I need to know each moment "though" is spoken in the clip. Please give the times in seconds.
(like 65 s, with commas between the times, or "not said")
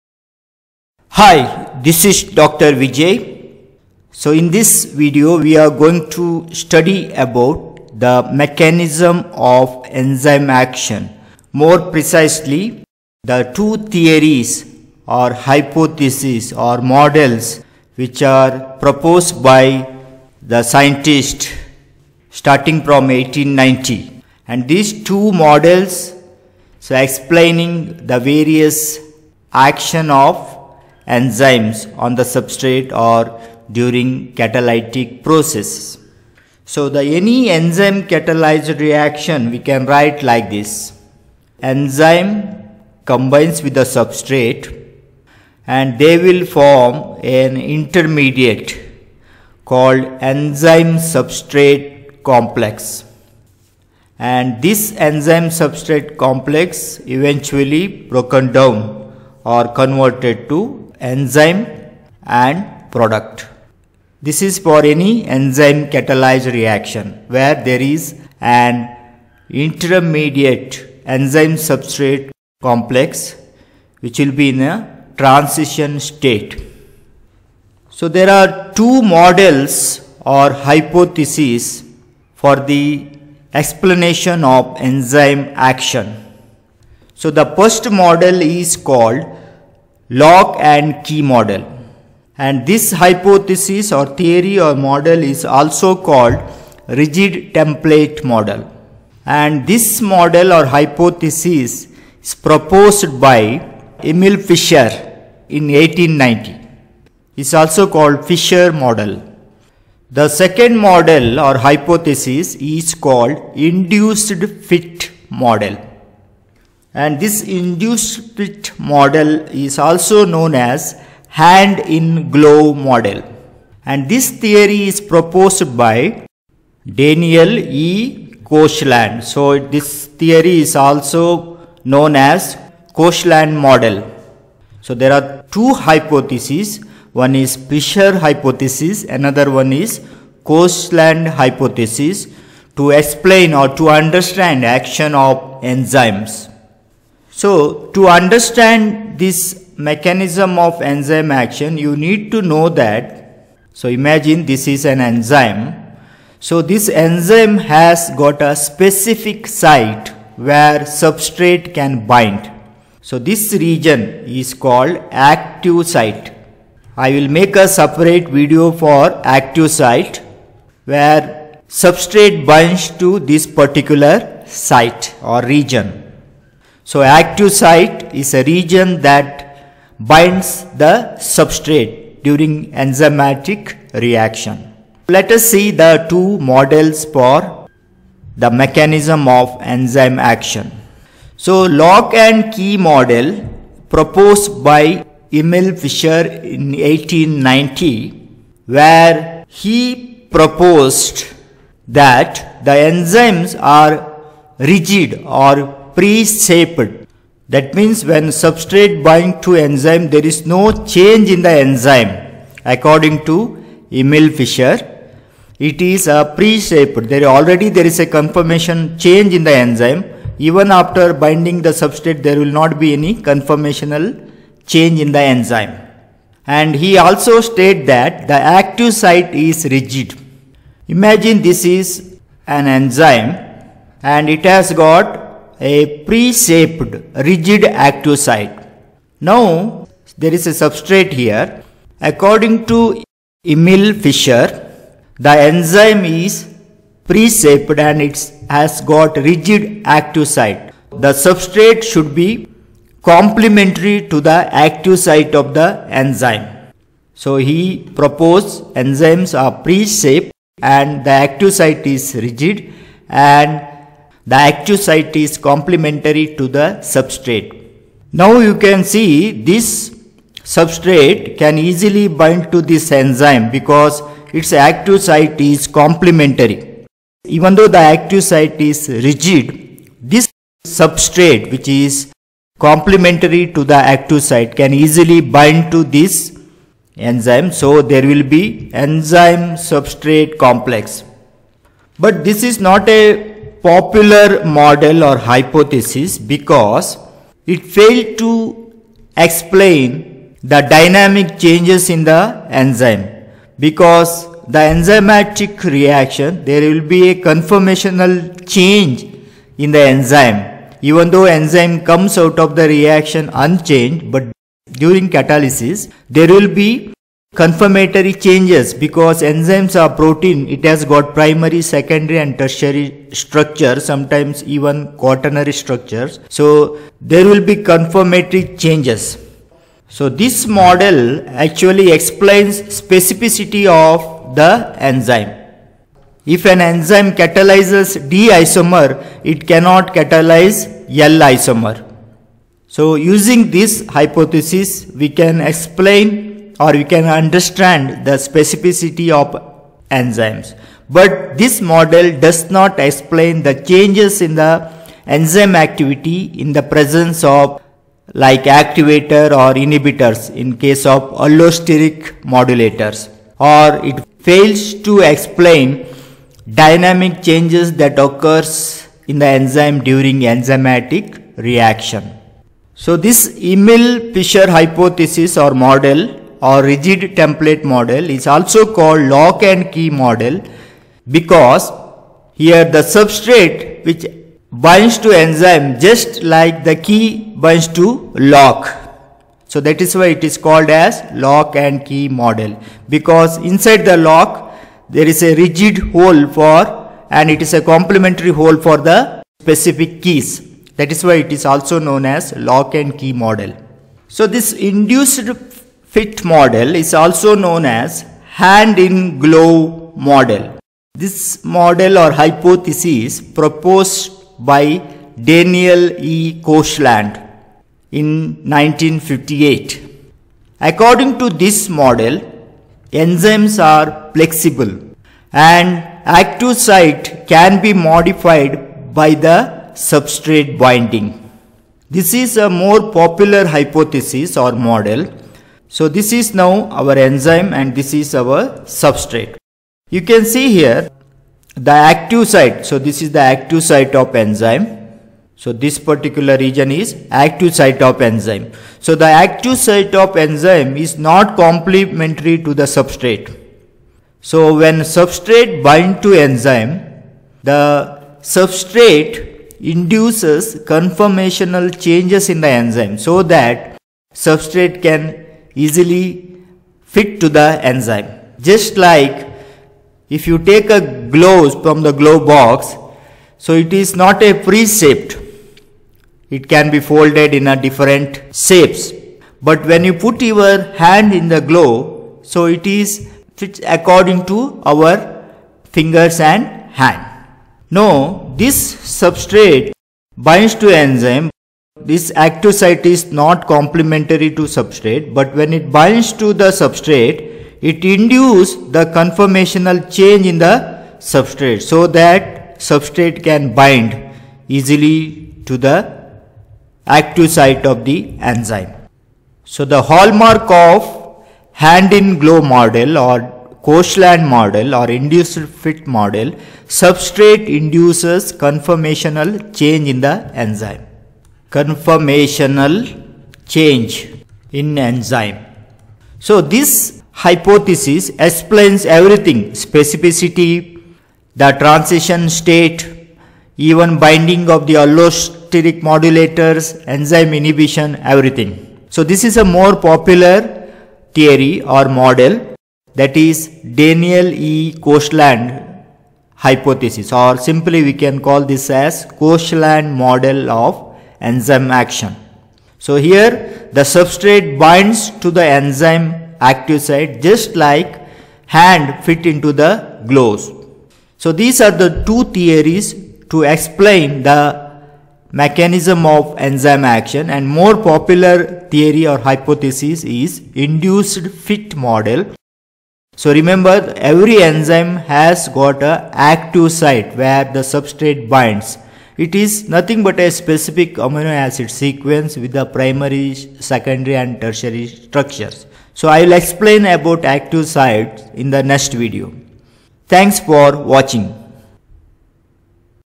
277 s, 311 s.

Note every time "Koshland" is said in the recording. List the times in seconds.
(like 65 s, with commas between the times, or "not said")
128 s, 132 s, 140 s, 416 s, 513 s, 544 s, 549 s.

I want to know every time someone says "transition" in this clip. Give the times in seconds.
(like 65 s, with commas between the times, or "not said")
75 s, 531 s.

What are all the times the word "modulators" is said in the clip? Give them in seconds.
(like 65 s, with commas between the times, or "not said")
362 s, 535 s.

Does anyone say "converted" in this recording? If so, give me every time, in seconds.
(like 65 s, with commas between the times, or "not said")
59 s.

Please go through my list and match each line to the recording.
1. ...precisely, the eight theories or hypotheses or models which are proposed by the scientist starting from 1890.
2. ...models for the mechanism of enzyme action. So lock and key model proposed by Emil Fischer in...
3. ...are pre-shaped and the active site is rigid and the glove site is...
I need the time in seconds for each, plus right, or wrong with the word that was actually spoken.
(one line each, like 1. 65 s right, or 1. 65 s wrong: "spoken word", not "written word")
1. 11 s wrong: "two", not "eight"
2. 186 s right
3. 259 s wrong: "active", not "glove".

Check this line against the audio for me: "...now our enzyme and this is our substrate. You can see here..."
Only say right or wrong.
right.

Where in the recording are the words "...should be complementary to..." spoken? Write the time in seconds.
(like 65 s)
251 s.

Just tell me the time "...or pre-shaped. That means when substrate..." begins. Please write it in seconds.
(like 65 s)
205 s.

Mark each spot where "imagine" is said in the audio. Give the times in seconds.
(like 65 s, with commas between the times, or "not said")
153 s, 230 s.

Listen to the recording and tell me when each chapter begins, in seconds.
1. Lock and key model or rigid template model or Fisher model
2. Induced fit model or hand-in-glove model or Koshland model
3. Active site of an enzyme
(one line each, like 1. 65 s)
1. 191 s
2. 404 s
3. 147 s.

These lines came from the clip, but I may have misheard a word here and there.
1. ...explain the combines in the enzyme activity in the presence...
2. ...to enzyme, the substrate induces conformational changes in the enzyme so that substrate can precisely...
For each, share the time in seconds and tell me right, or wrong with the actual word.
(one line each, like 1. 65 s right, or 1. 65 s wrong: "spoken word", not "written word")
1. 352 s wrong: "changes", not "combines"
2. 456 s wrong: "easily", not "precisely".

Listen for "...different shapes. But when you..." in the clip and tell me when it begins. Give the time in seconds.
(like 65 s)
477 s.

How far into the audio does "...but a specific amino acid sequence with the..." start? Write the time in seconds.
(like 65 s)
580 s.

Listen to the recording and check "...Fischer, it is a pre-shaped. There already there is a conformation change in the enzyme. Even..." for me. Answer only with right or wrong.
right.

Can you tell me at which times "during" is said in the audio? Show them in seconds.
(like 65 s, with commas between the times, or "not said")
33 s, 182 s, 314 s, 369 s.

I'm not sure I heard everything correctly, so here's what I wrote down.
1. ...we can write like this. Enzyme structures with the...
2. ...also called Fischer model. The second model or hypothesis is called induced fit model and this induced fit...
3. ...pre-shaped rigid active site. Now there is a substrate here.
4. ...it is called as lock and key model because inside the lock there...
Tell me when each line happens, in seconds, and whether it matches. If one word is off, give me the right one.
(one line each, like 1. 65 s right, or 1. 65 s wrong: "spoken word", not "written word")
1. 39 s wrong: "combines", not "structures"
2. 107 s right
3. 236 s right
4. 390 s right.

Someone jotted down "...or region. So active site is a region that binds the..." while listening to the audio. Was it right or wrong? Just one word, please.
right.